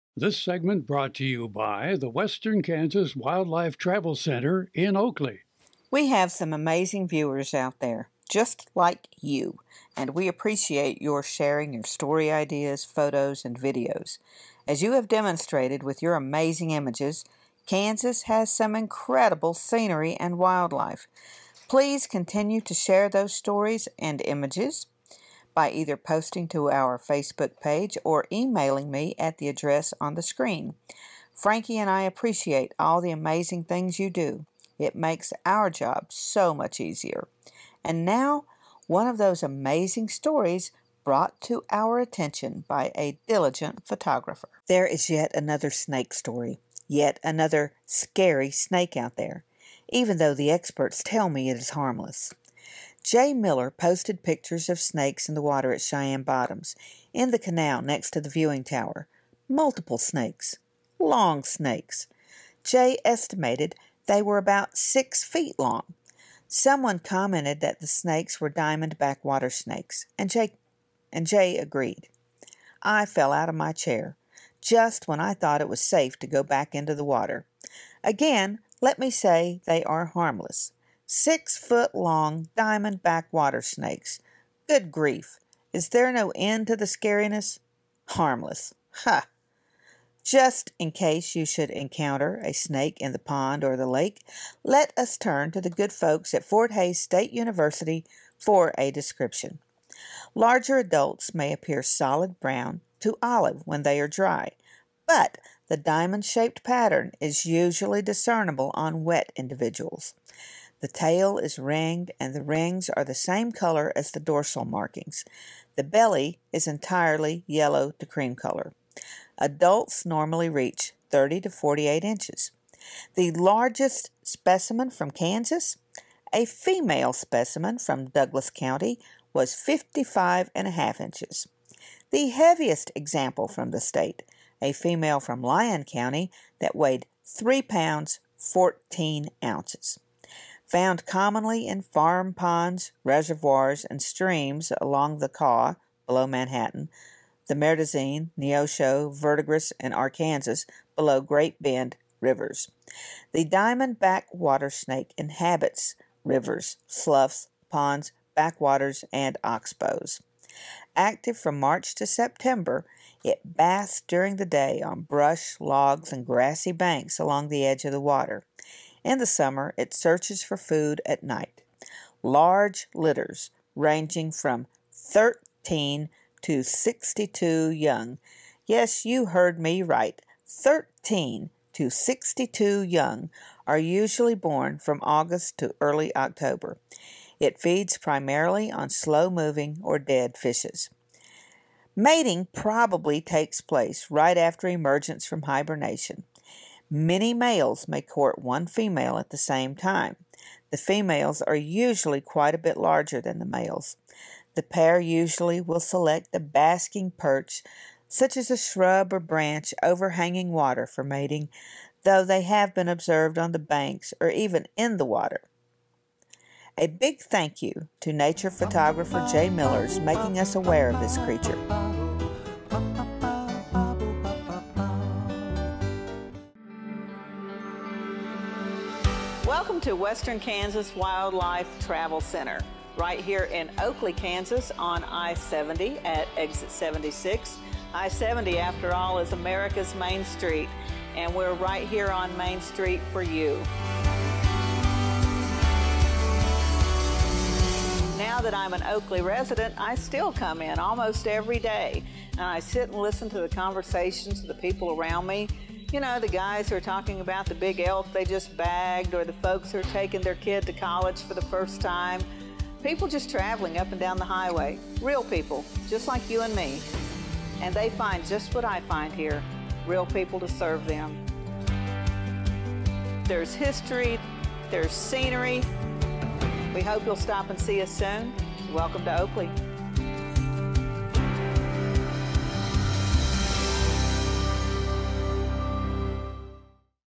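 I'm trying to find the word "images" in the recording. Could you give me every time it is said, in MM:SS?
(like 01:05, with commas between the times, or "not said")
00:16, 00:24.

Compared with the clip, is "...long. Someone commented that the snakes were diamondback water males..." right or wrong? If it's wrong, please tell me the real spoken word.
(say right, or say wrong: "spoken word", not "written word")
wrong: "snakes", not "males".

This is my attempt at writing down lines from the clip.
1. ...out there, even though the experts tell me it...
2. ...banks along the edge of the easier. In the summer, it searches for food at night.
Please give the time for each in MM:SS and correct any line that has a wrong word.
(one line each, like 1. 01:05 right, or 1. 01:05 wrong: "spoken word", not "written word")
1. 00:48 right
2. 02:46 wrong: "water", not "easier".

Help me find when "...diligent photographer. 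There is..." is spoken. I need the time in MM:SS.
00:43.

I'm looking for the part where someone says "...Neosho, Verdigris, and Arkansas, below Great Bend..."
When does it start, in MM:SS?
02:28.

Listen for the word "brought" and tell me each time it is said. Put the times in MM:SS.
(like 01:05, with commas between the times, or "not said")
00:00, 00:41.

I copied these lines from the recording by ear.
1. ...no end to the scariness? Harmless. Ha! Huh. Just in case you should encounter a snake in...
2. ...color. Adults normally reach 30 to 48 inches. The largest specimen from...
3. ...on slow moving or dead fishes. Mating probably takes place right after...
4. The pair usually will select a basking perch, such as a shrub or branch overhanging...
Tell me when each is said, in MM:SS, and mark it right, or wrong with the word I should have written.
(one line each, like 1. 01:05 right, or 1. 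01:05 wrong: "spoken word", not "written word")
1. 01:26 right
2. 01:58 right
3. 03:08 right
4. 03:24 right.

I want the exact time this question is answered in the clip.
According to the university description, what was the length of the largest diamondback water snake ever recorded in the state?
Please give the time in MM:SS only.
02:09.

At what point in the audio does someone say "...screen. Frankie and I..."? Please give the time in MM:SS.
00:30.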